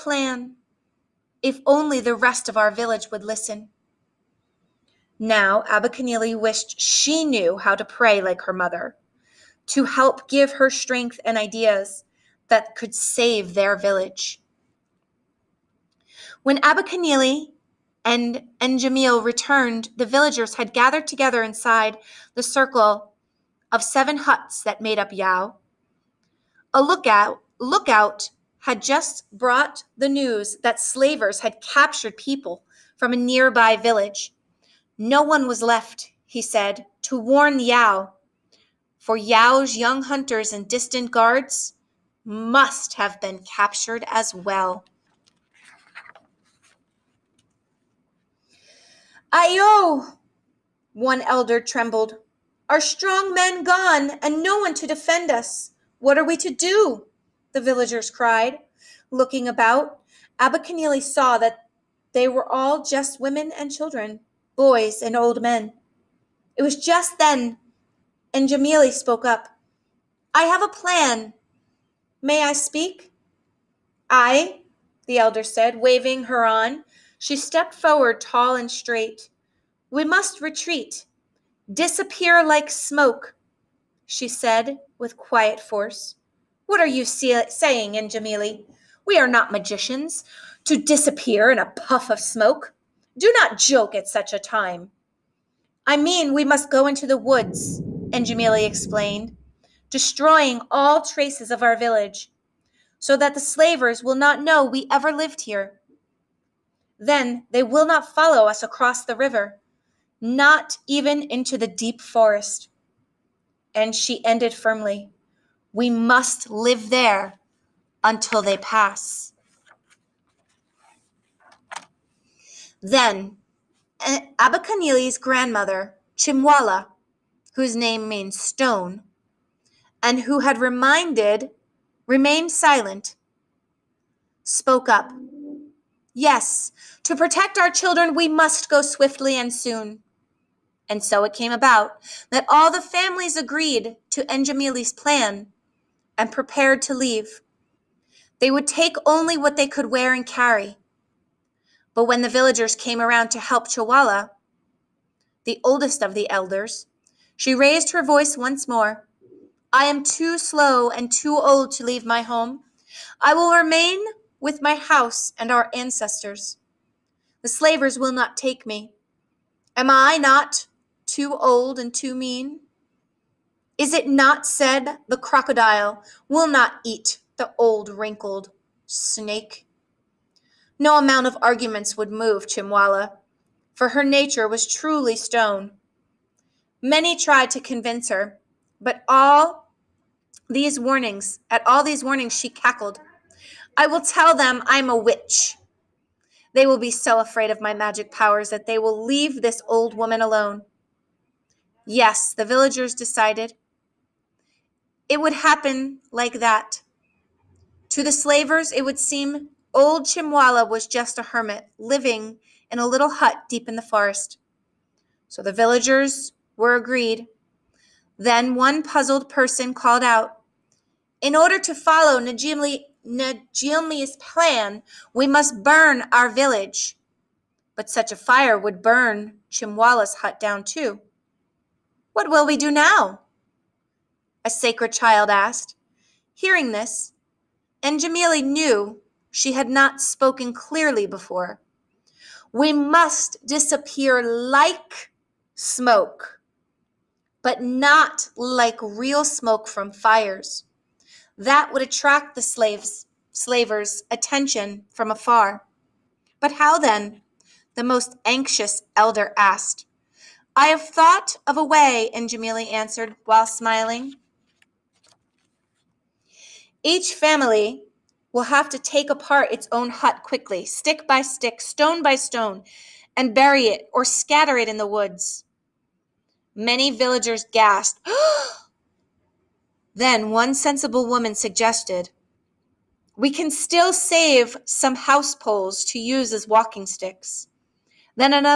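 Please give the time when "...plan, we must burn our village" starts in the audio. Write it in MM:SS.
03:44.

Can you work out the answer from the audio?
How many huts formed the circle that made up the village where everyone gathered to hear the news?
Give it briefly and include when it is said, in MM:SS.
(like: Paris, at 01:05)
7, at 00:23.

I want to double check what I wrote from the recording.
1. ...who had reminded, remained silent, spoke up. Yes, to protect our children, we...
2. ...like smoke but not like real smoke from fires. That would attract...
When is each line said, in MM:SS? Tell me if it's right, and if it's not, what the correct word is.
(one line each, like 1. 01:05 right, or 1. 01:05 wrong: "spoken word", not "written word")
1. 02:10 right
2. 04:04 right.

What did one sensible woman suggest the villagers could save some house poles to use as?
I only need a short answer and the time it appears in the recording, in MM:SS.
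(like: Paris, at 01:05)
Walking sticks, at 04:46.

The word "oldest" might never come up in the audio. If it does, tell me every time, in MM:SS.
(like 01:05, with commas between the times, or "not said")
02:35.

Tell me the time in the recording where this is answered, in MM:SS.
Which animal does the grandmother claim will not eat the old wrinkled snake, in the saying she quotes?
02:55.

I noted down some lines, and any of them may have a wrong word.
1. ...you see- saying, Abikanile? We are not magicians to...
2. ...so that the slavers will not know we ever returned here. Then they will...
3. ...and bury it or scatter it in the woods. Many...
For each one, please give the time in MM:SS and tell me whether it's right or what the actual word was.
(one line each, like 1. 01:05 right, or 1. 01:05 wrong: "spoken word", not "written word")
1. 01:26 wrong: "Njemile", not "Abikanile"
2. 01:42 wrong: "lived", not "returned"
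3. 04:33 right.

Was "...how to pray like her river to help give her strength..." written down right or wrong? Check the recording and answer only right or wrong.
wrong.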